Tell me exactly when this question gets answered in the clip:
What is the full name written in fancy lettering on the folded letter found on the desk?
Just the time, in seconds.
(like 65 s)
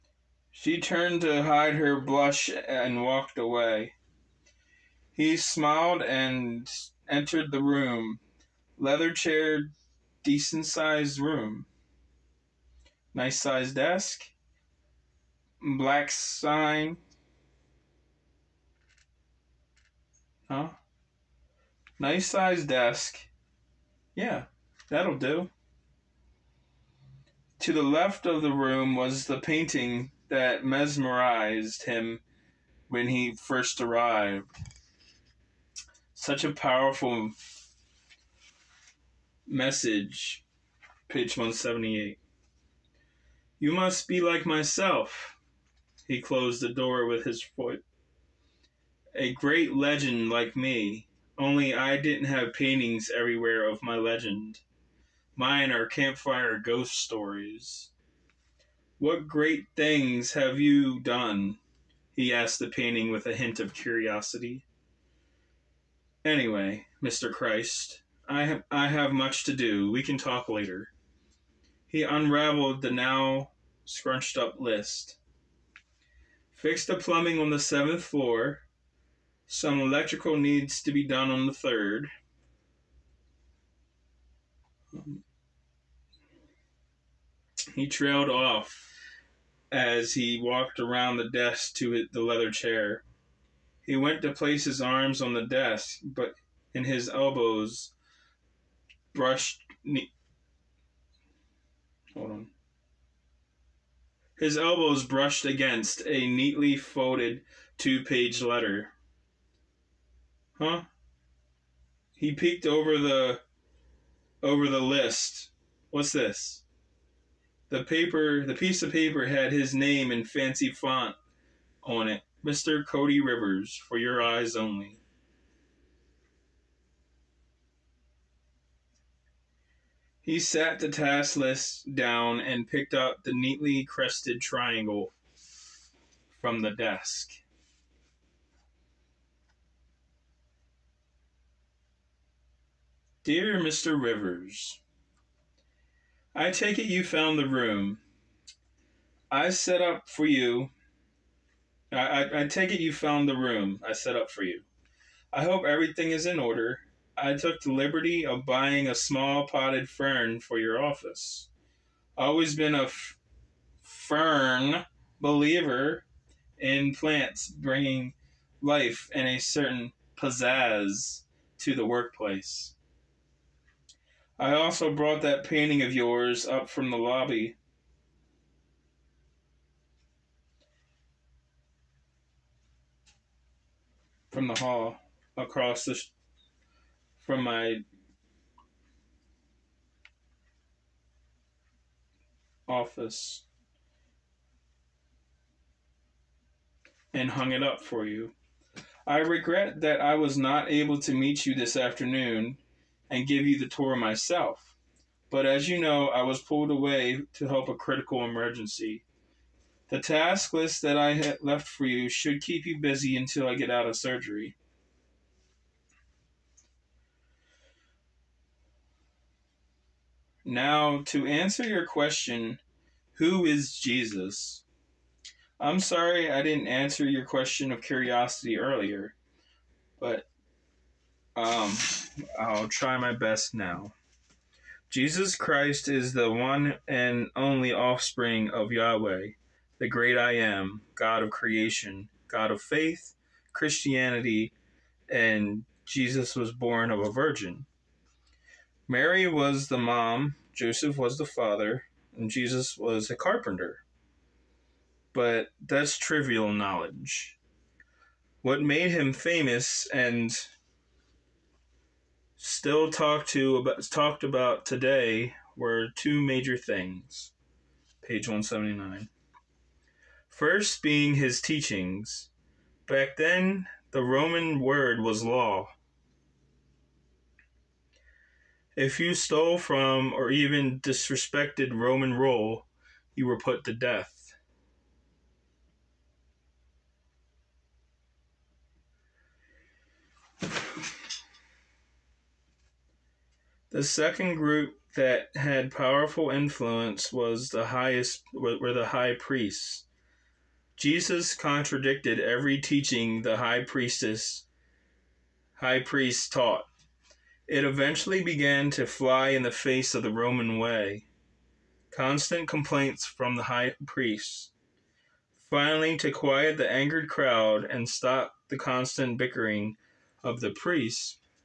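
122 s.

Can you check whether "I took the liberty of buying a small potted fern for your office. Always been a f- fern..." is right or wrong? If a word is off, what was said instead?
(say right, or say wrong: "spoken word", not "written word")
right.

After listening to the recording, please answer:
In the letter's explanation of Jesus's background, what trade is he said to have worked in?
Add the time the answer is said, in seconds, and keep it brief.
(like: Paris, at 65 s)
Carpenter, at 253 s.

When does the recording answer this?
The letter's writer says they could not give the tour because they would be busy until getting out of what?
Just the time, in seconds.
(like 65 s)
213 s.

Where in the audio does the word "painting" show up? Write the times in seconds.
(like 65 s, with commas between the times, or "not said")
29 s, 52 s, 62 s, 175 s.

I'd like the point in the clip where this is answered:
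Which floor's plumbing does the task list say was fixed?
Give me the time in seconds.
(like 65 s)
77 s.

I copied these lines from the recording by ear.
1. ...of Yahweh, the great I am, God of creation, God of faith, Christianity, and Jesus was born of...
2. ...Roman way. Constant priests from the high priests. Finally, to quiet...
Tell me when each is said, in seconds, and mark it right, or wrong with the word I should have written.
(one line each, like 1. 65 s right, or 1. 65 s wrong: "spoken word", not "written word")
1. 238 s right
2. 310 s wrong: "complaints", not "priests".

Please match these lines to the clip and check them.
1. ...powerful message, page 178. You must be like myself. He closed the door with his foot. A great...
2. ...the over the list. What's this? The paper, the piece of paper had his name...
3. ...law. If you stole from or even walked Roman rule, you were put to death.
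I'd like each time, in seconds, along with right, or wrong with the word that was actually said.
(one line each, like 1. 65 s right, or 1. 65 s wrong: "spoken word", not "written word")
1. 36 s right
2. 112 s right
3. 275 s wrong: "disrespected", not "walked".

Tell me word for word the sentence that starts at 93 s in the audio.
He went to place his arms on the desk, but in his elbows brushed.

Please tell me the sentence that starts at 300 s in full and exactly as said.
Jesus contradicted every teaching the high priestess high priest taught.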